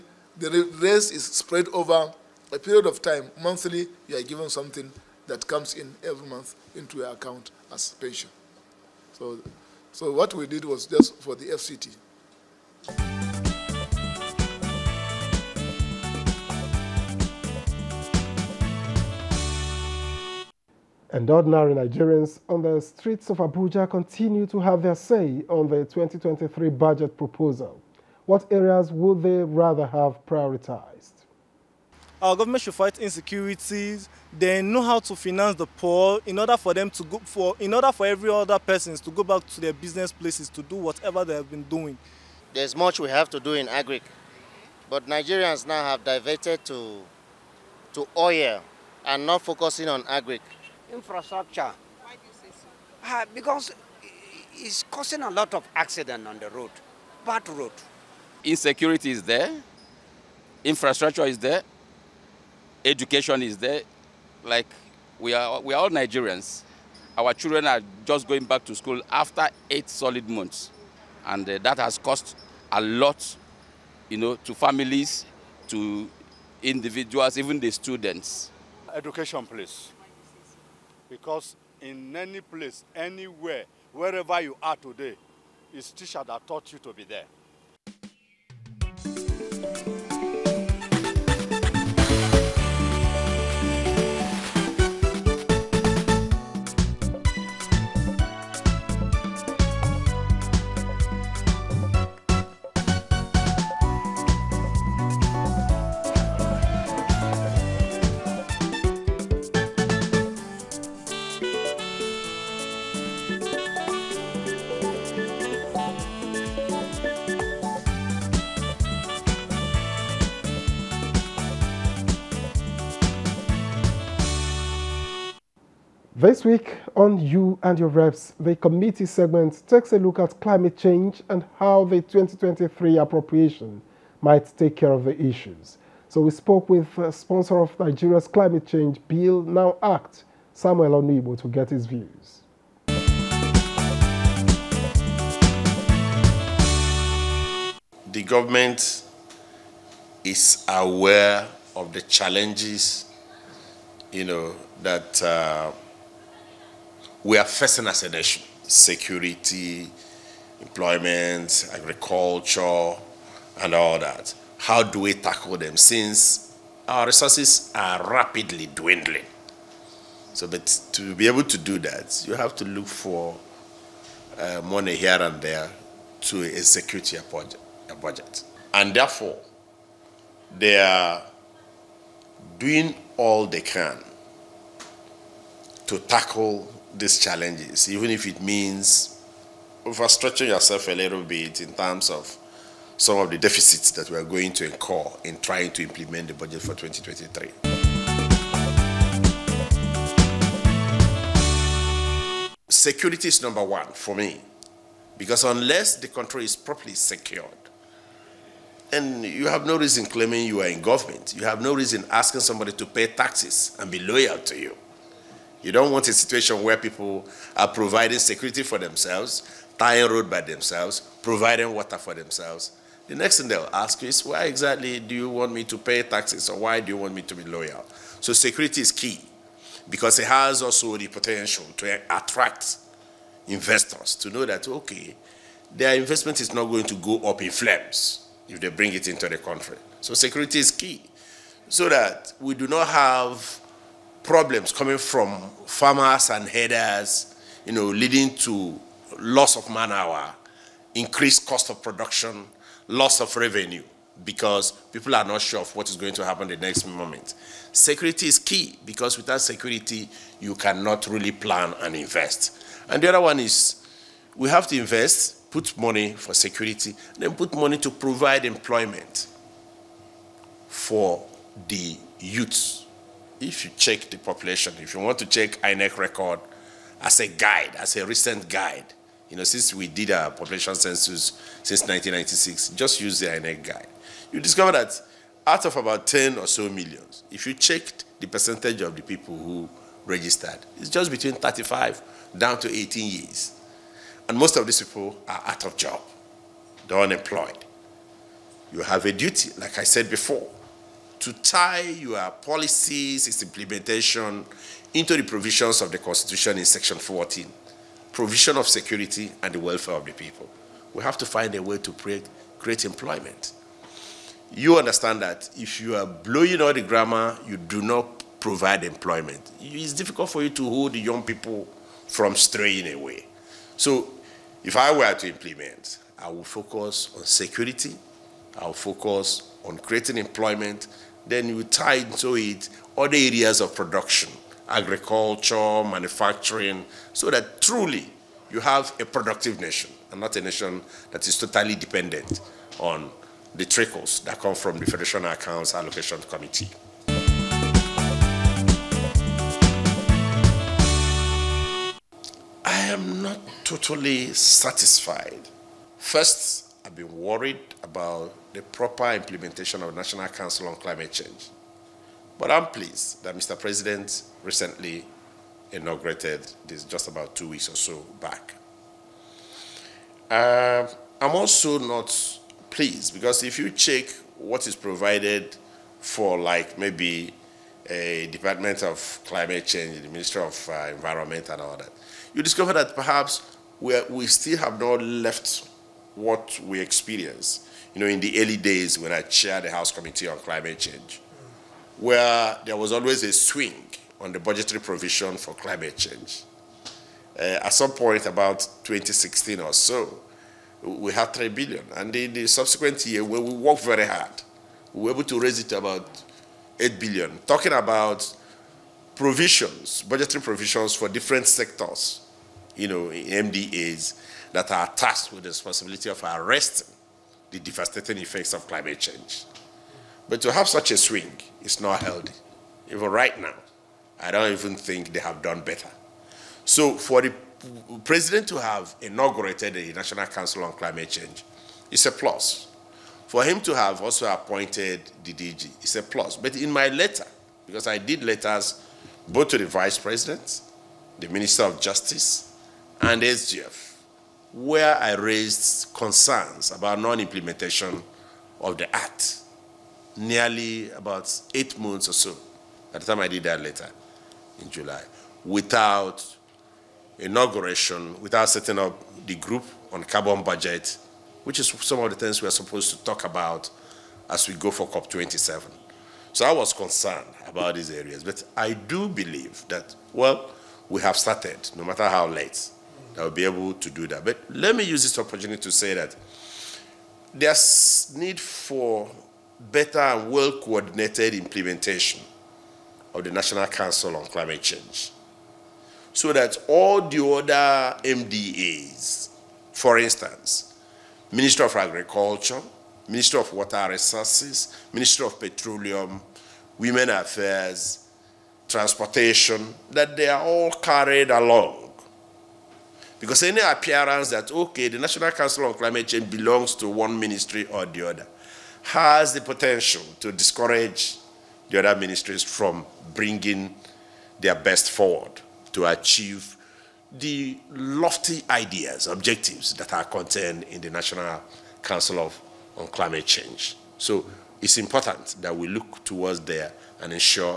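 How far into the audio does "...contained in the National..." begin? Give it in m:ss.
8:40.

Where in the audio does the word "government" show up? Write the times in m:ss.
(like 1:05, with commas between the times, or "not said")
0:32, 2:28, 3:30.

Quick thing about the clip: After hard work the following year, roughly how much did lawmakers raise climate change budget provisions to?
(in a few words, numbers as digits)
8 billion.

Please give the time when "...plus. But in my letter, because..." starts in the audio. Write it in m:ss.
7:16.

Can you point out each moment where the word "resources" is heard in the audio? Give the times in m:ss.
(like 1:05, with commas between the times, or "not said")
2:47, 8:13.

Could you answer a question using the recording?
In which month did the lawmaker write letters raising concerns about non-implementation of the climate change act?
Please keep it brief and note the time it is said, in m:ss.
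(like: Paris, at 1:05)
July, at 7:34.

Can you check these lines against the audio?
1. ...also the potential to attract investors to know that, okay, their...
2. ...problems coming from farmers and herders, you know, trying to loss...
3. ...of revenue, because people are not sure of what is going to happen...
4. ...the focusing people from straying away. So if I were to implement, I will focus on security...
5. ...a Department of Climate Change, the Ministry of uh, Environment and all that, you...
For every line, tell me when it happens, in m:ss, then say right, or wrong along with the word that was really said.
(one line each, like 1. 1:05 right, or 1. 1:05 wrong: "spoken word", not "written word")
1. 3:50 right
2. 4:04 wrong: "leading", not "trying"
3. 4:13 right
4. 5:20 wrong: "young", not "focusing"
5. 6:17 right.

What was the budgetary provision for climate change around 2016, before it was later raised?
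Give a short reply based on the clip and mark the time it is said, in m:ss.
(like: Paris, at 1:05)
3 billion, at 6:41.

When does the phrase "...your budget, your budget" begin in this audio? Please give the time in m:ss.
2:57.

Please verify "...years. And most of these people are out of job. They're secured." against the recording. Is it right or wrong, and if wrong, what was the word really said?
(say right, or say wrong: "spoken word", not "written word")
wrong: "unemployed", not "secured".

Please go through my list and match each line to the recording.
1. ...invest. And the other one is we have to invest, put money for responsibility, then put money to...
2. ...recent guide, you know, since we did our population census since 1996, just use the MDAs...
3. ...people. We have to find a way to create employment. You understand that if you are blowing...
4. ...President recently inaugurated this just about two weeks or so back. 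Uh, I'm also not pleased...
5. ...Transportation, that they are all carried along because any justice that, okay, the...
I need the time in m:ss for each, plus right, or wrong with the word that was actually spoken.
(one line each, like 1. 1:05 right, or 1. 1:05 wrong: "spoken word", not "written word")
1. 4:21 wrong: "security", not "responsibility"
2. 4:38 wrong: "INEC", not "MDAs"
3. 5:10 right
4. 6:03 right
5. 8:18 wrong: "appearance", not "justice".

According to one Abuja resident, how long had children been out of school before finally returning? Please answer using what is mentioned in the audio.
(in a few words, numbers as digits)
8 months.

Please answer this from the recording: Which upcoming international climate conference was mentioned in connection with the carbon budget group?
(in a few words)
COP27.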